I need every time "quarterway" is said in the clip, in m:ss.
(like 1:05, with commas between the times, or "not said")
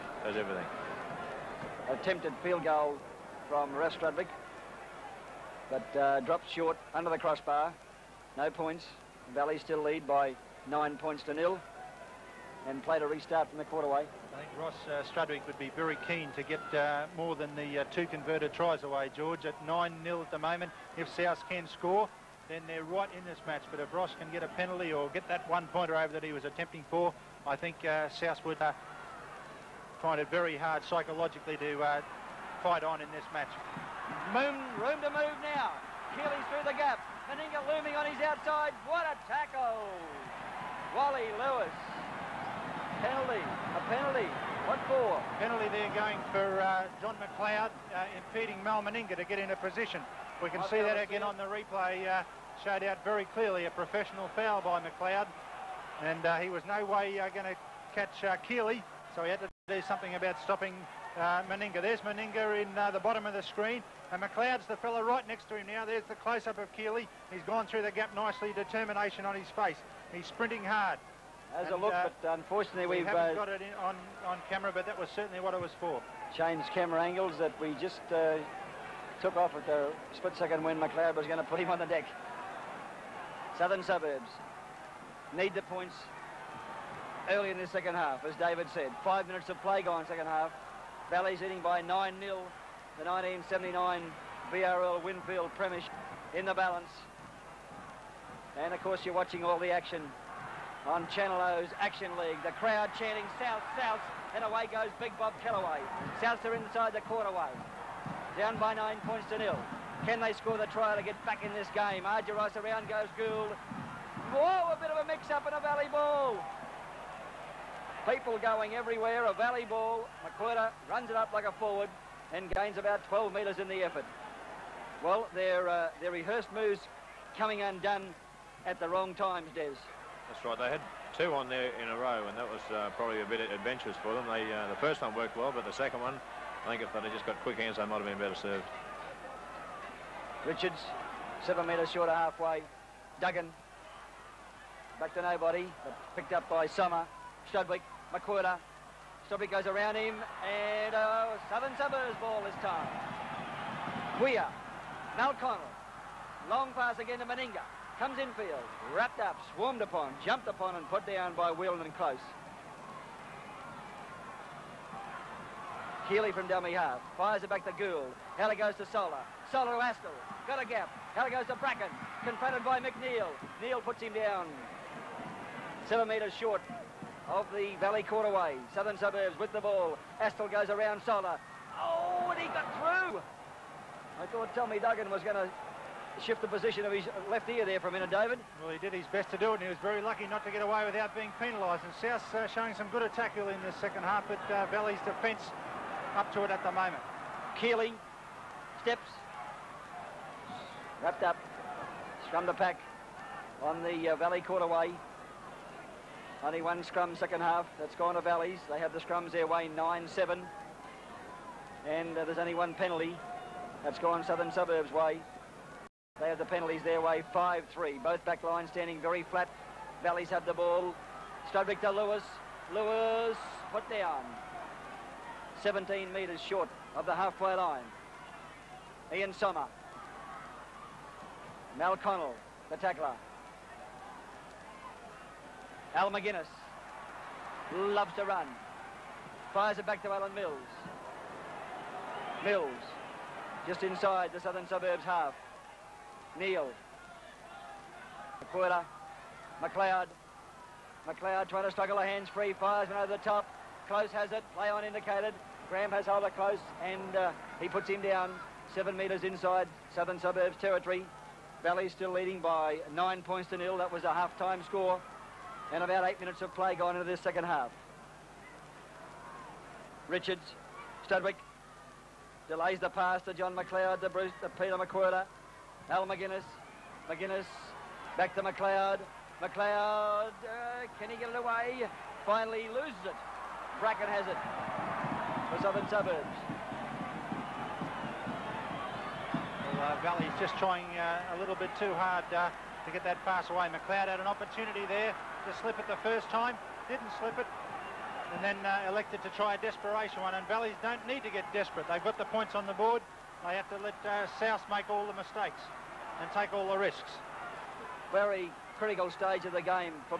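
0:13, 1:47, 2:58, 3:24.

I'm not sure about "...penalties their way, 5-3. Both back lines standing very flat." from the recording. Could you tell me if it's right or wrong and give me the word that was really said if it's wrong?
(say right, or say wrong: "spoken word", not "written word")
right.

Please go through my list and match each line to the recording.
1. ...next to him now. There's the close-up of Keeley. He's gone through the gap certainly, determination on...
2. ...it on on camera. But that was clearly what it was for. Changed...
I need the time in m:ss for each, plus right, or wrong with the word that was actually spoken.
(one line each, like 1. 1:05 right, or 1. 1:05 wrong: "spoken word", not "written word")
1. 1:05 wrong: "nicely", not "certainly"
2. 1:13 wrong: "certainly", not "clearly".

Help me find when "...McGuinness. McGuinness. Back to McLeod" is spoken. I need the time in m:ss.
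4:36.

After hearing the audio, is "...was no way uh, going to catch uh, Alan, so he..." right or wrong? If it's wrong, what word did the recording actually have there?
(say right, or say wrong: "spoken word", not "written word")
wrong: "Keeley", not "Alan".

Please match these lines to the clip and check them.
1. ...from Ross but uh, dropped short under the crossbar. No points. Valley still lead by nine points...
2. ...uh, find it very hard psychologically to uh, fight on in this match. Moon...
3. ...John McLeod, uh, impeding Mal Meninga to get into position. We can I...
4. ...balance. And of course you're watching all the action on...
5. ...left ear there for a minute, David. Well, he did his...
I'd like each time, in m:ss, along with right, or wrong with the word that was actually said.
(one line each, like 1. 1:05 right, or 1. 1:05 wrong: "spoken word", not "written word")
1. 0:03 right
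2. 0:28 right
3. 0:47 right
4. 1:36 right
5. 3:07 right.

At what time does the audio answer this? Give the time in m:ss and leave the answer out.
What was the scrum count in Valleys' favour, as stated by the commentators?
3:29.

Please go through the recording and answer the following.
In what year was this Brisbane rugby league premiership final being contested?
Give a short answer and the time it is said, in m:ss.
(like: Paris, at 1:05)
1979, at 1:33.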